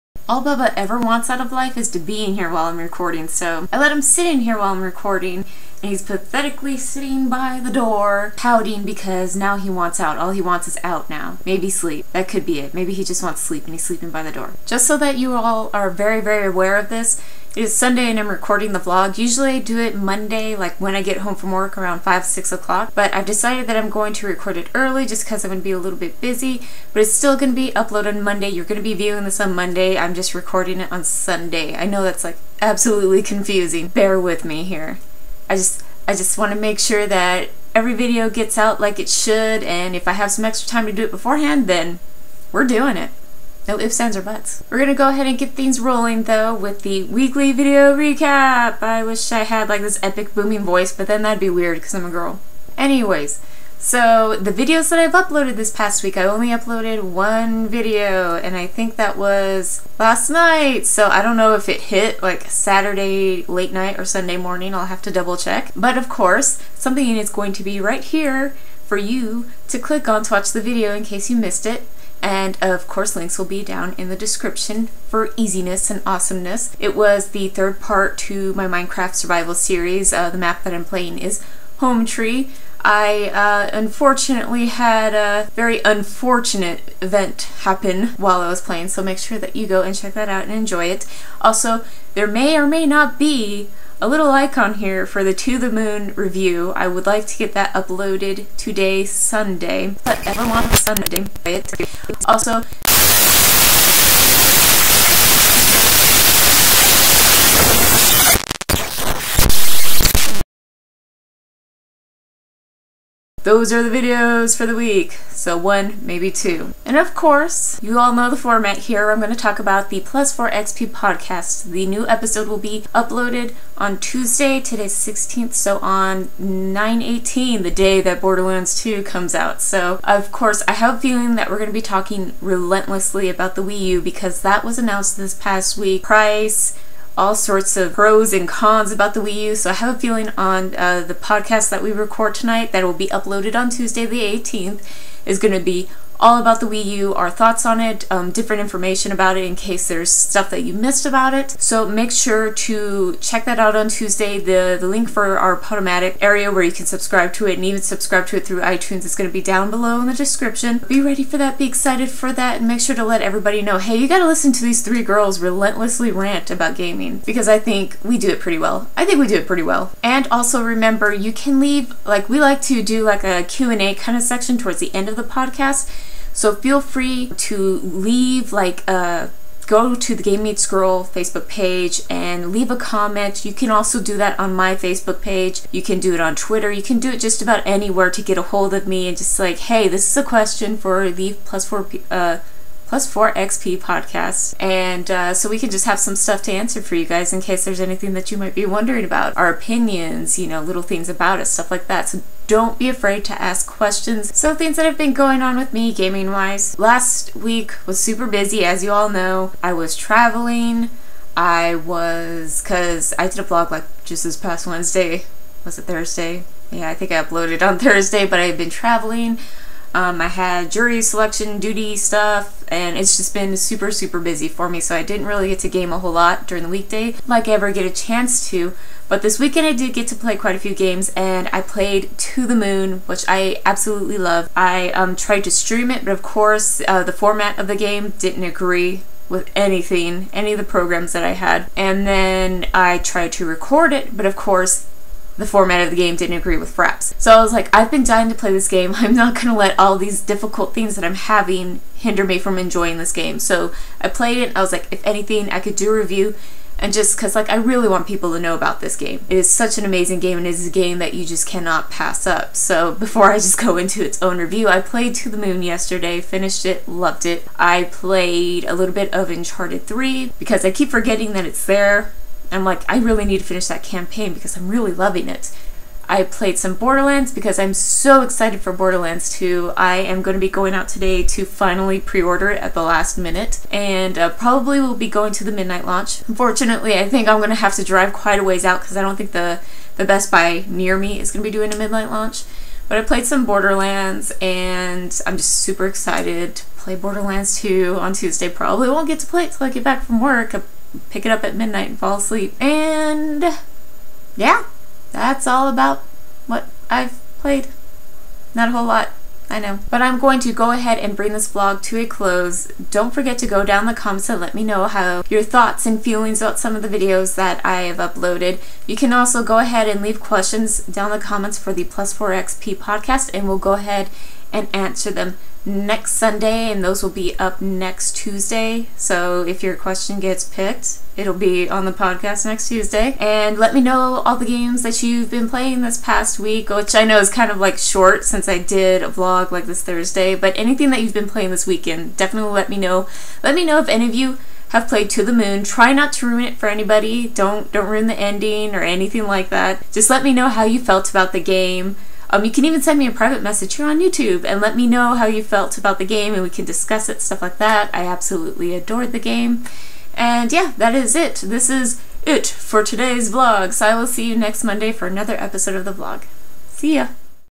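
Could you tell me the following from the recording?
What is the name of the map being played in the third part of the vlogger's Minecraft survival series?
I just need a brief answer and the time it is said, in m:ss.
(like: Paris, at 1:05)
Home Tree, at 1:21.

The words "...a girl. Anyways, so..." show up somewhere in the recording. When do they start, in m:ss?
0:52.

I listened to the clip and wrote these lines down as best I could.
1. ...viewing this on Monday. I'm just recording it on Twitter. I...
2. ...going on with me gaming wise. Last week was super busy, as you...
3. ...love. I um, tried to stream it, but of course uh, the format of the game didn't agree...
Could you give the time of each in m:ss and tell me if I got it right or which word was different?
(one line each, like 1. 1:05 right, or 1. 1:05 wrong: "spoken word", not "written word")
1. 0:28 wrong: "Sunday", not "Twitter"
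2. 3:25 right
3. 3:54 right.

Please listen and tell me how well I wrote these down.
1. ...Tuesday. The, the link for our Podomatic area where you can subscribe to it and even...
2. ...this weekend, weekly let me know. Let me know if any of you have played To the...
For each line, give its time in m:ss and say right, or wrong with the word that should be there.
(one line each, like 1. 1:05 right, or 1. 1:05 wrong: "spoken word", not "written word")
1. 2:33 right
2. 5:41 wrong: "definitely", not "weekly".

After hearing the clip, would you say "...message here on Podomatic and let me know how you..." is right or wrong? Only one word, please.
wrong.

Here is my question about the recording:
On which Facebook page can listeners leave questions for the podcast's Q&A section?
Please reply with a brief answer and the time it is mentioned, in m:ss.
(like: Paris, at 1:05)
Game Meets Girl, at 3:00.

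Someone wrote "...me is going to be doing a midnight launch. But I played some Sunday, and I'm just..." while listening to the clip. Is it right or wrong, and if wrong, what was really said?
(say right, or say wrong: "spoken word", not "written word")
wrong: "Borderlands", not "Sunday".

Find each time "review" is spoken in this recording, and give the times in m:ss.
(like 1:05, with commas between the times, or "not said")
1:36, 4:15, 4:24.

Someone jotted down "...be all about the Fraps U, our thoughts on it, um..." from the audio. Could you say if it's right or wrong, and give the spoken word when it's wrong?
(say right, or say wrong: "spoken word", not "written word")
wrong: "Wii", not "Fraps".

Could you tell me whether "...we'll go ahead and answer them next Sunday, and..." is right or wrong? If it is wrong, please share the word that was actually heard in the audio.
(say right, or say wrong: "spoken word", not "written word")
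right.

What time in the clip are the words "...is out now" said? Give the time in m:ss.
0:10.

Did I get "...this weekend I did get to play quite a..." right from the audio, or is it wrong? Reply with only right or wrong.
right.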